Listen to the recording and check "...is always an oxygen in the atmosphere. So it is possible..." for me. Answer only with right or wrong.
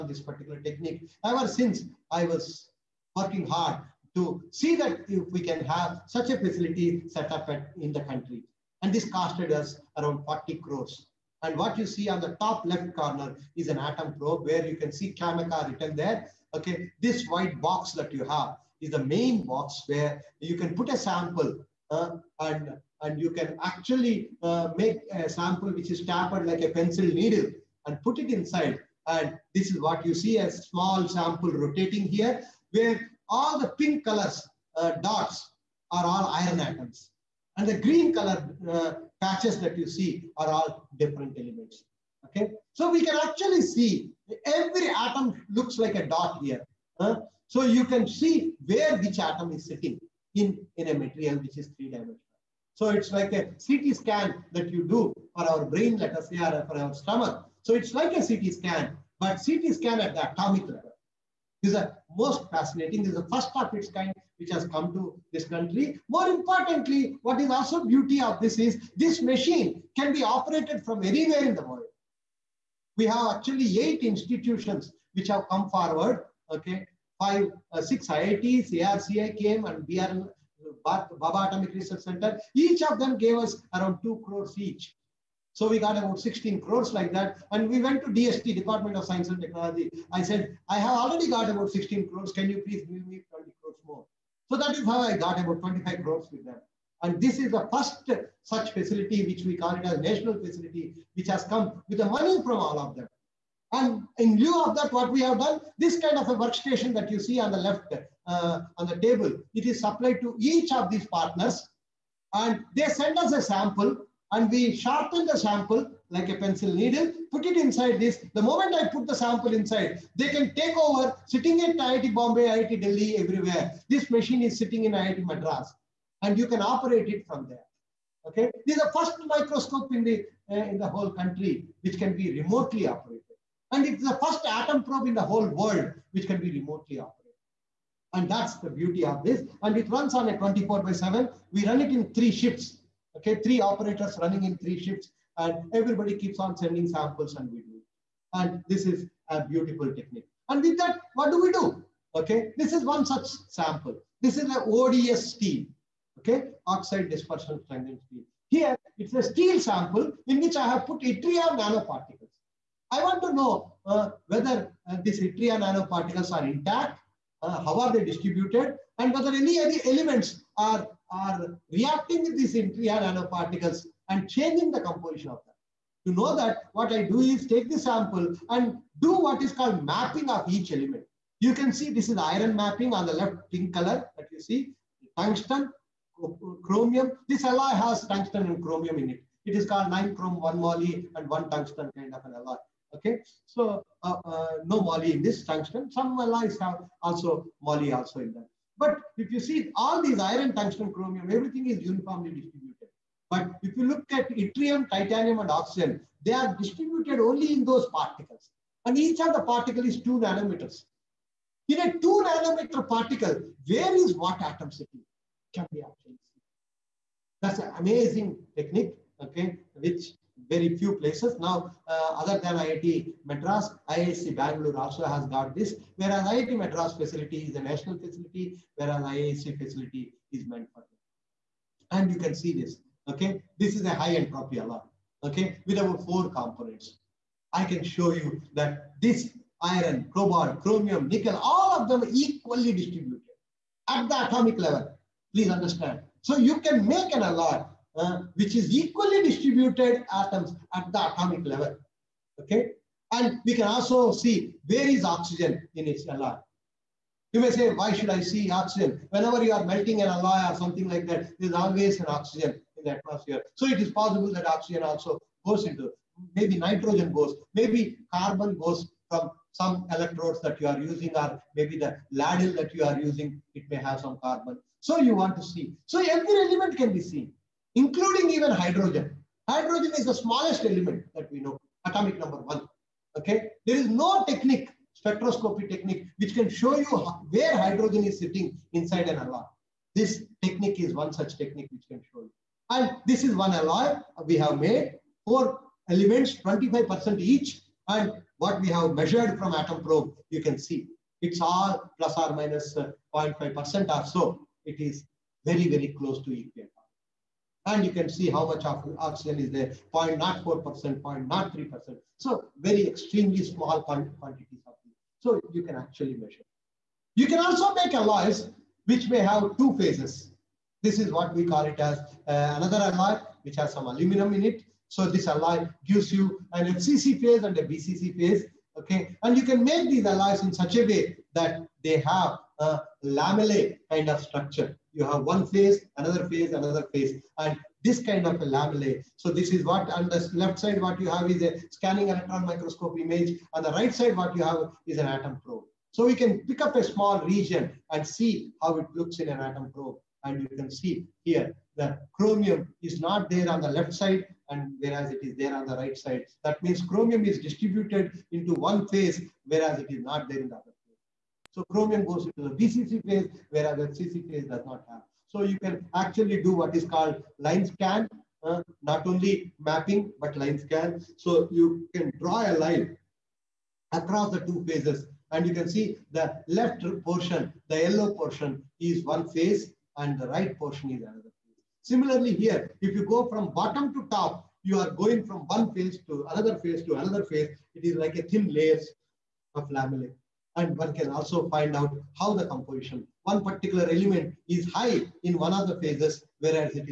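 right.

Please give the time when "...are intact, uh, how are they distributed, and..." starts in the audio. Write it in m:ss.
2:46.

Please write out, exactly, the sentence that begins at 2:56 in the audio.
To know that, what I do is take the sample and do what is called mapping of each element.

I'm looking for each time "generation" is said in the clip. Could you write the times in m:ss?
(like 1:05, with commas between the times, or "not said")
not said.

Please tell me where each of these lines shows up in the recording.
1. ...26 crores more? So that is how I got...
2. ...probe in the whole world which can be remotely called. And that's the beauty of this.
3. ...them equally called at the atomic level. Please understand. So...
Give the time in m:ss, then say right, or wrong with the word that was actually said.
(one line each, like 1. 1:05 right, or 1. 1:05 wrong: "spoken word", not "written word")
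1. 1:33 wrong: "20", not "26"
2. 2:14 wrong: "operated", not "called"
3. 4:01 wrong: "distributed", not "called".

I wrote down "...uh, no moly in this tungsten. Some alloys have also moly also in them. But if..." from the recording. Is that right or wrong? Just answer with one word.
right.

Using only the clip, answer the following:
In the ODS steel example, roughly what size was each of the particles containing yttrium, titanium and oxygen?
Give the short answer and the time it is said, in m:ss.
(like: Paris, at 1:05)
2 nanometers, at 3:30.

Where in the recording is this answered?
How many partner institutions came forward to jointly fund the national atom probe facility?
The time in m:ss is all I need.
1:13.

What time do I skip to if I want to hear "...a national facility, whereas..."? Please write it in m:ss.
3:47.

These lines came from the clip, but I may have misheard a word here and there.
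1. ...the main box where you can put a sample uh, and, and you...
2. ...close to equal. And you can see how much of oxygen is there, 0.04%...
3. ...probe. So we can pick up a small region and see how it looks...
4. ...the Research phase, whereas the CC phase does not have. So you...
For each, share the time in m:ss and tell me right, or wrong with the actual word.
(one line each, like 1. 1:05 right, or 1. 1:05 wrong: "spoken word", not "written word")
1. 0:18 right
2. 5:05 right
3. 5:45 right
4. 6:02 wrong: "BCC", not "Research".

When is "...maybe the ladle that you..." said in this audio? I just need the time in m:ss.
4:31.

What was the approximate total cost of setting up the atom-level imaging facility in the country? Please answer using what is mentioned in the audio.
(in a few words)
40 crores.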